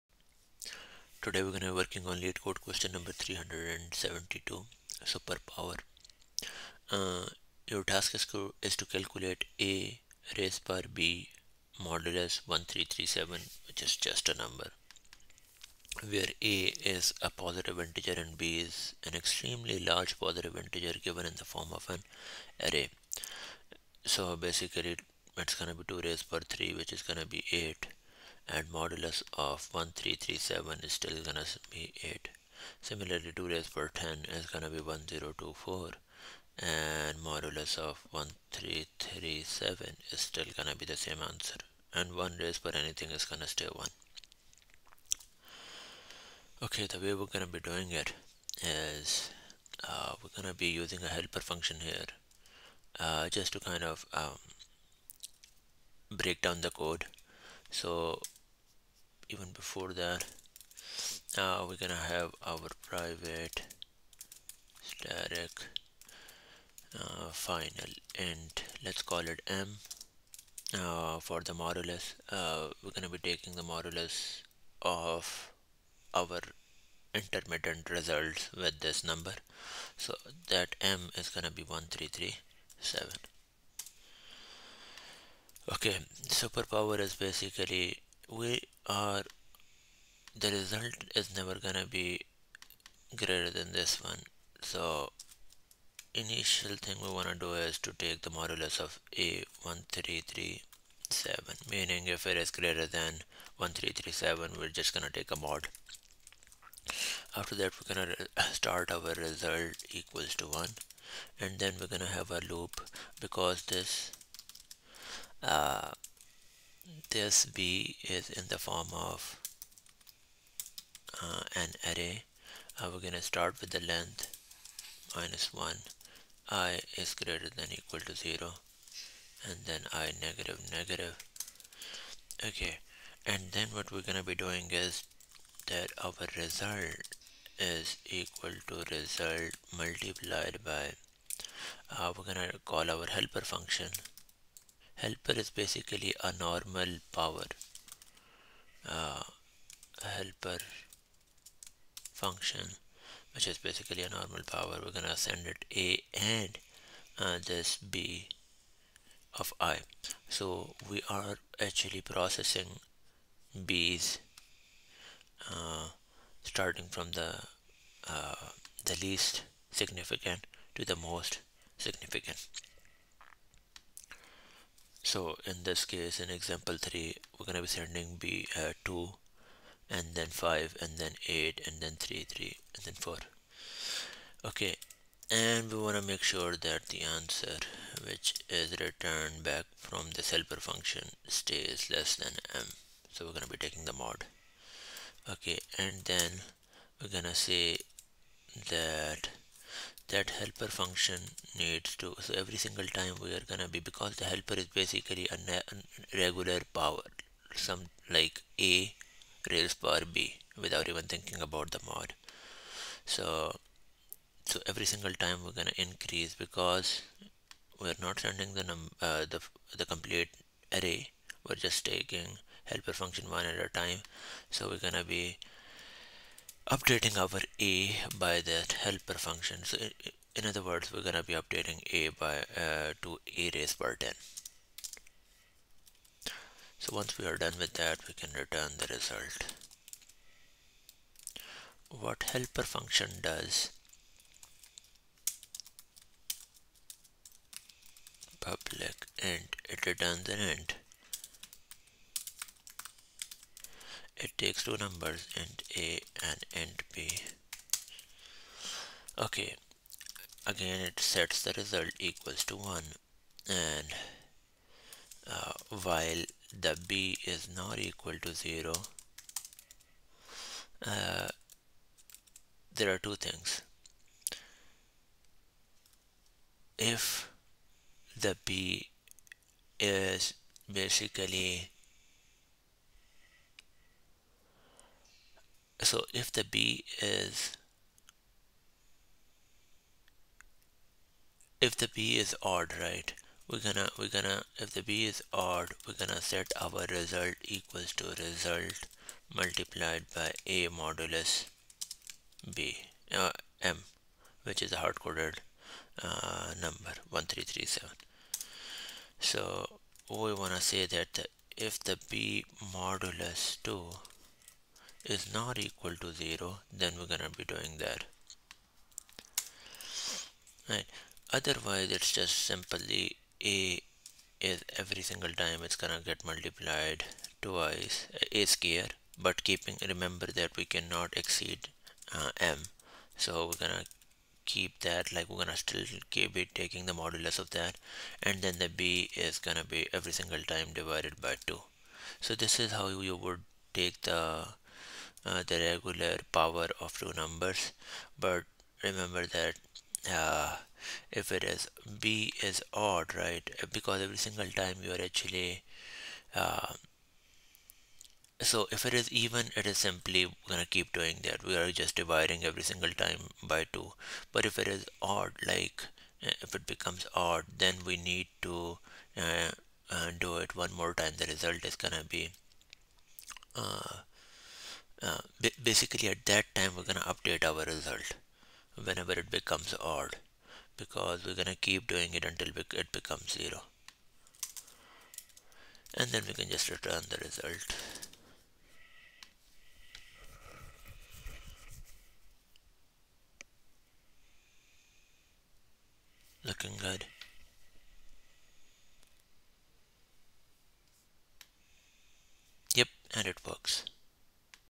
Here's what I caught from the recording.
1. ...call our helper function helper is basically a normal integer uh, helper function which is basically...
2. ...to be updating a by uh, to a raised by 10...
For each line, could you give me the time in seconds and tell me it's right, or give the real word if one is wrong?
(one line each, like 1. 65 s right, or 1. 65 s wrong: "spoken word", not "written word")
1. 142 s wrong: "power", not "integer"
2. 231 s right.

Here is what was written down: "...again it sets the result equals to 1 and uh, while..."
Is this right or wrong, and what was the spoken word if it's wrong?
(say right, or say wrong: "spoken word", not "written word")
right.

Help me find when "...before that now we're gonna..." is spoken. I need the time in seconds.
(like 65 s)
59 s.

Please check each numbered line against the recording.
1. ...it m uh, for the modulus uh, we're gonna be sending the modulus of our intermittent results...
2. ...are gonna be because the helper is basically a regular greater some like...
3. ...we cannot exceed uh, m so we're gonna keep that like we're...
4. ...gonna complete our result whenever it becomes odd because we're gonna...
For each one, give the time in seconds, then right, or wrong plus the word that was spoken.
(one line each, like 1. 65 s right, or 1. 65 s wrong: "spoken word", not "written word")
1. 69 s wrong: "taking", not "sending"
2. 203 s wrong: "power", not "greater"
3. 330 s right
4. 376 s wrong: "update", not "complete".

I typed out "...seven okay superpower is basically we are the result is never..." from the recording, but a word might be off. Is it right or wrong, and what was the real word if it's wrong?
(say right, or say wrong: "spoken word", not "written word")
right.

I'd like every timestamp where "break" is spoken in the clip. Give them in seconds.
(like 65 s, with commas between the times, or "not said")
56 s.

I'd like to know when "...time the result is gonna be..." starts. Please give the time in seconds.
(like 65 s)
370 s.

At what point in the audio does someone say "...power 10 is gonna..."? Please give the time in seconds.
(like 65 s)
33 s.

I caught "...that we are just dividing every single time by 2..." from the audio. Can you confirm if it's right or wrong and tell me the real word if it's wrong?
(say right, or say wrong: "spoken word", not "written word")
right.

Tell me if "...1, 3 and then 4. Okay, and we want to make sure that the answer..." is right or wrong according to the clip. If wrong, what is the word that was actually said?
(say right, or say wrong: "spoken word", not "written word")
wrong: "3", not "1".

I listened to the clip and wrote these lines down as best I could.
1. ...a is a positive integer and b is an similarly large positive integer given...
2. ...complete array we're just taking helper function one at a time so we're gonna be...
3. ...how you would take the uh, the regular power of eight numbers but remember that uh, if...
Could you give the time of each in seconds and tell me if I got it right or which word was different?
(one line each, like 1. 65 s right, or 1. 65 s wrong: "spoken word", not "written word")
1. 16 s wrong: "extremely", not "similarly"
2. 219 s right
3. 342 s wrong: "two", not "eight".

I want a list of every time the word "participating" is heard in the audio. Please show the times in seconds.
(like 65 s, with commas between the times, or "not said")
not said.